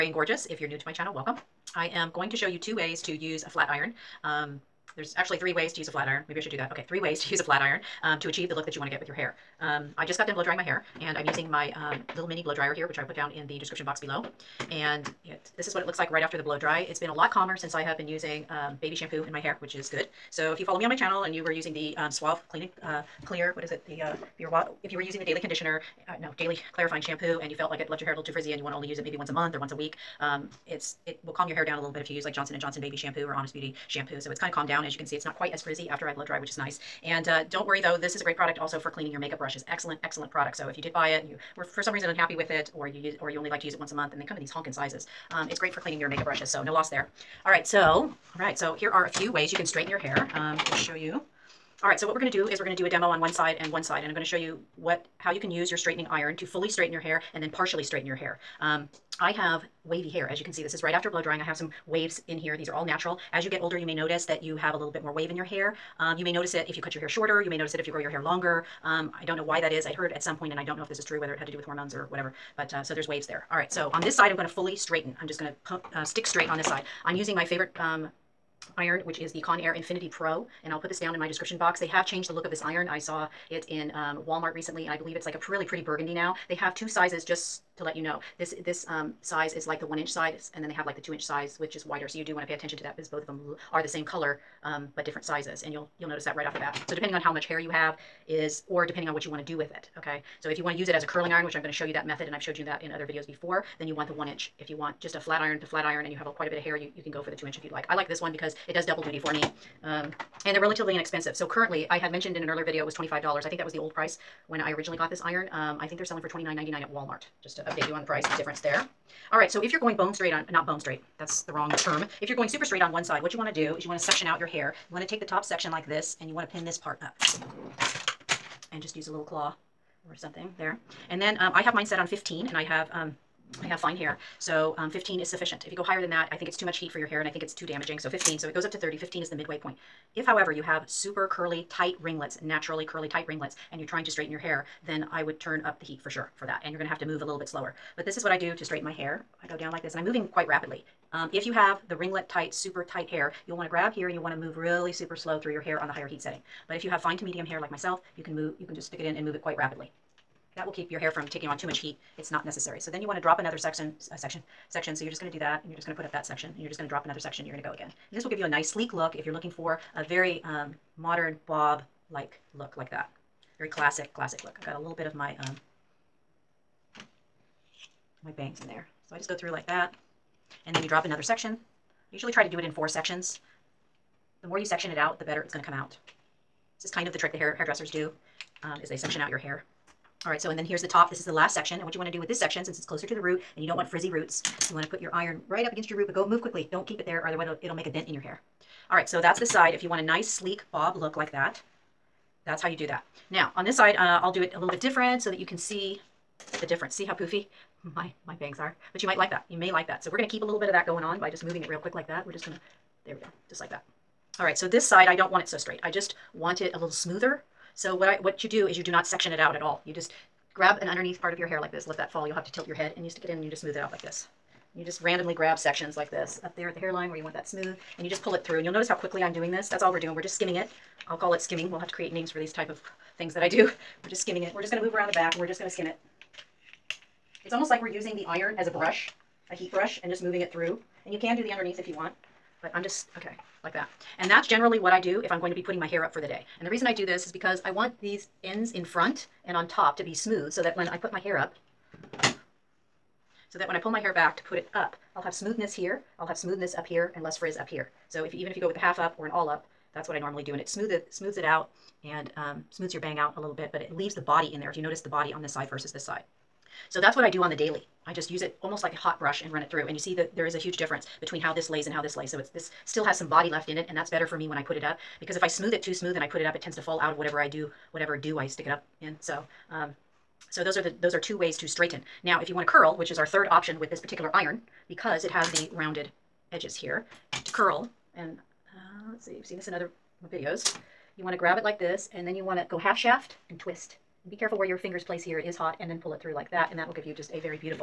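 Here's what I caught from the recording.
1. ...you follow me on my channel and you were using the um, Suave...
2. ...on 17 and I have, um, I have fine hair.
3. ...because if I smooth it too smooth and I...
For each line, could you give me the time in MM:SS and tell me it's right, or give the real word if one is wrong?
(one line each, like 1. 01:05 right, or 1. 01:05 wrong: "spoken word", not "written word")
1. 00:20 right
2. 02:11 wrong: "15", not "17"
3. 04:35 right.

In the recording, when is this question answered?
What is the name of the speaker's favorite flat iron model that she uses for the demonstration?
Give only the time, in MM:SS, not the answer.
01:19.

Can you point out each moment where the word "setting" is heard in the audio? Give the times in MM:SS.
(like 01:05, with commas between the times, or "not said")
02:36.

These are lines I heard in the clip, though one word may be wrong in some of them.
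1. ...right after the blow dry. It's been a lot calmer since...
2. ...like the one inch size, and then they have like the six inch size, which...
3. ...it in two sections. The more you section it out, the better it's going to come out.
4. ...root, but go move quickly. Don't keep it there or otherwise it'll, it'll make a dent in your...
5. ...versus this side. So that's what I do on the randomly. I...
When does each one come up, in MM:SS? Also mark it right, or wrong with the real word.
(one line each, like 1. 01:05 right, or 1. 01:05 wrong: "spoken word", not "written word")
1. 00:16 right
2. 01:29 wrong: "two", not "six"
3. 03:02 wrong: "four", not "two"
4. 03:15 right
5. 04:25 wrong: "daily", not "randomly".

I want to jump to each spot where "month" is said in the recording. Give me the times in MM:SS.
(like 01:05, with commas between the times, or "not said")
00:29, 00:43.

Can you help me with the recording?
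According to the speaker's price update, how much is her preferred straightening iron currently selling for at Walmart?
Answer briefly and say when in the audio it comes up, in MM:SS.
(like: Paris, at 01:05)
$29.99, at 01:56.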